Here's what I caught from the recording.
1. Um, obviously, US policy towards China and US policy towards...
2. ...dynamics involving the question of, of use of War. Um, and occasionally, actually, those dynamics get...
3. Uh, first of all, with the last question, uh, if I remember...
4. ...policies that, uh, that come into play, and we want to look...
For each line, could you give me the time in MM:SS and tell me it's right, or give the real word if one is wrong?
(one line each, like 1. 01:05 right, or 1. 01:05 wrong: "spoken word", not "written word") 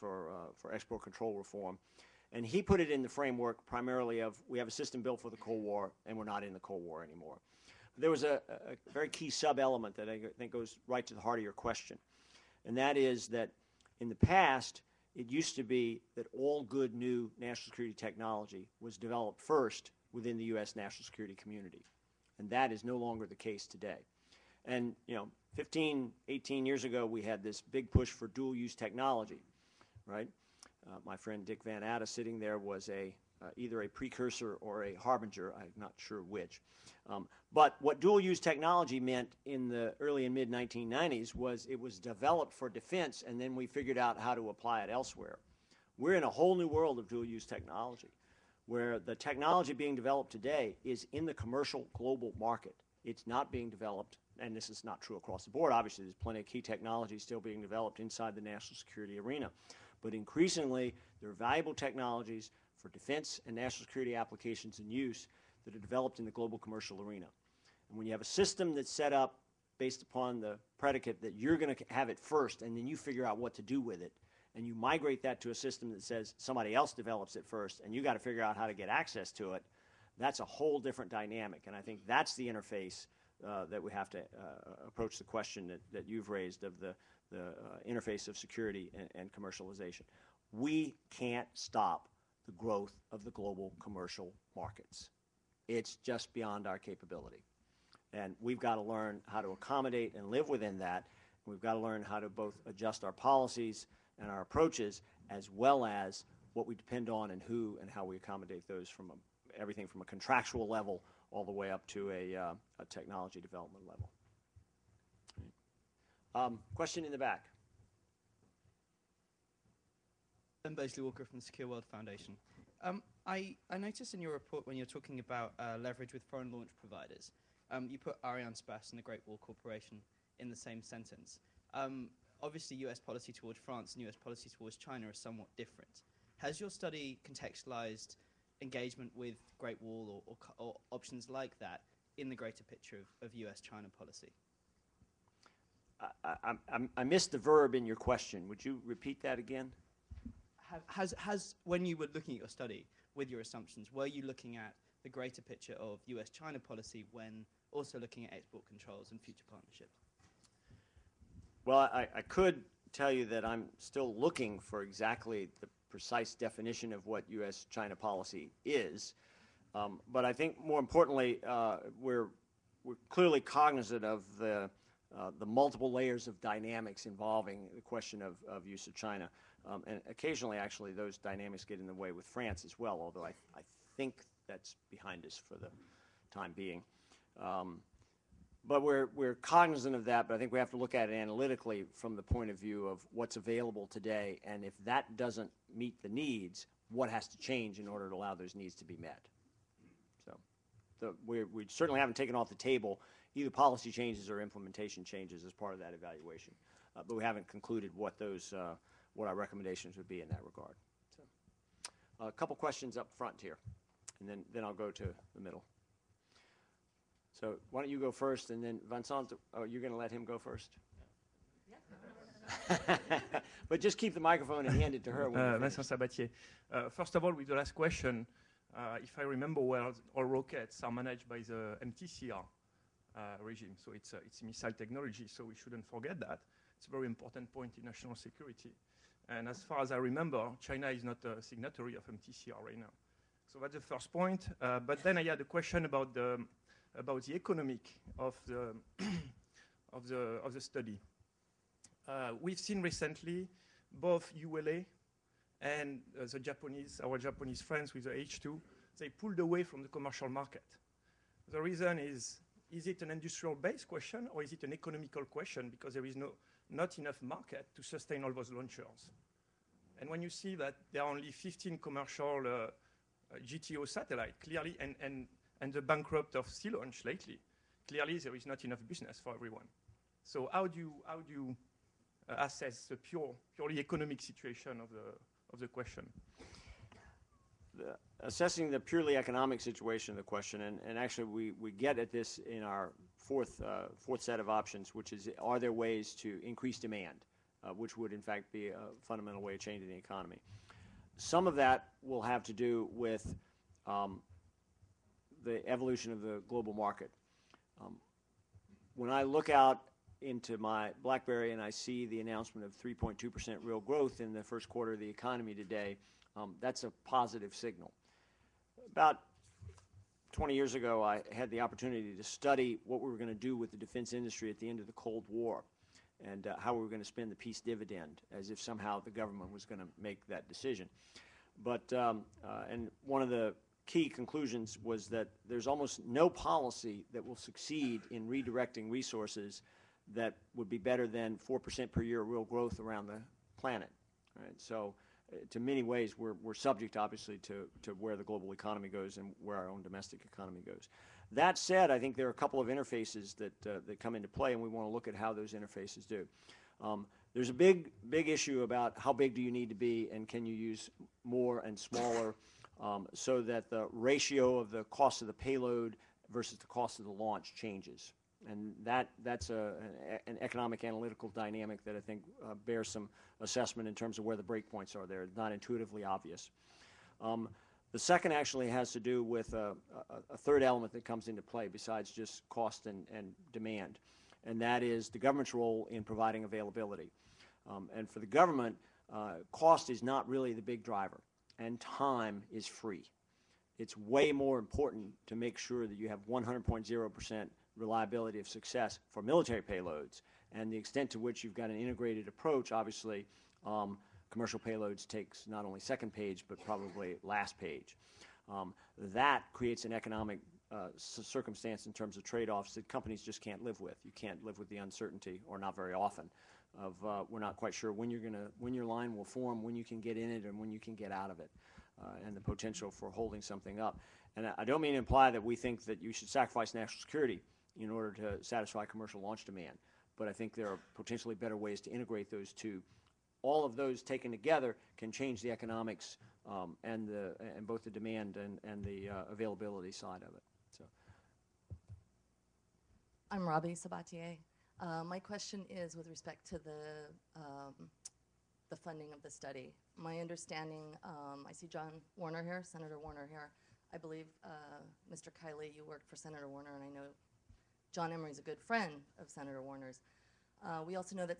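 1. 02:11 wrong: "France", not "China"
2. 02:56 wrong: "China", not "War"
3. 03:46 right
4. 05:52 wrong: "interfaces", not "policies".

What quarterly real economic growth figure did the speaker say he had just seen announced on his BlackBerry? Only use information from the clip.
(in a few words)
3.2%.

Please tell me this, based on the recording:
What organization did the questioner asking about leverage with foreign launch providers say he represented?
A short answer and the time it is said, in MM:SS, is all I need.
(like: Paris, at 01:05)
Secure World Foundation, at 02:01.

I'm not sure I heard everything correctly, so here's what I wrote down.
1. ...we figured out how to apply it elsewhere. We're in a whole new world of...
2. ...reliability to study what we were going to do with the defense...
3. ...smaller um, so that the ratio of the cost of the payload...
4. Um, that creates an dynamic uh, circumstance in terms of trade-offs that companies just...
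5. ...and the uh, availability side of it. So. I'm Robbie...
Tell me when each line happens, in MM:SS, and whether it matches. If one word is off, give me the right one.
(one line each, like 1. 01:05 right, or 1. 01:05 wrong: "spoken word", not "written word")
1. 00:43 right
2. 05:21 wrong: "opportunity", not "reliability"
3. 06:01 right
4. 06:48 wrong: "economic", not "dynamic"
5. 07:18 right.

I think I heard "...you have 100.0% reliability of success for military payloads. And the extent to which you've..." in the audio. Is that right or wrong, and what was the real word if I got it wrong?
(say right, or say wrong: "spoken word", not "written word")
right.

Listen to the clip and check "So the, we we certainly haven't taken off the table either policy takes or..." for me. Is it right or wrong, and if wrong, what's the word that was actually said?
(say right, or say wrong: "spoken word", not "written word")
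wrong: "changes", not "takes".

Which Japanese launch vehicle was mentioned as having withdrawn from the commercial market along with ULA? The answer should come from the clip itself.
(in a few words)
H2.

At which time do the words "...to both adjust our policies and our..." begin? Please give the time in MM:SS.
01:42.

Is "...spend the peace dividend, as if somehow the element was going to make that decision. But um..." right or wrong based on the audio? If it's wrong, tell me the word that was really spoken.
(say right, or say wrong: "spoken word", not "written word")
wrong: "government", not "element".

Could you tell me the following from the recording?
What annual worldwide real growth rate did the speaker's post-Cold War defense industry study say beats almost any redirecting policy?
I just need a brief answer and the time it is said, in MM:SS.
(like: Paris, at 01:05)
4%, at 05:41.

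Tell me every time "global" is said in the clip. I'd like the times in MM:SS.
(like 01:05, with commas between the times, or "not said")
00:51, 01:06, 01:33, 05:06, 05:48.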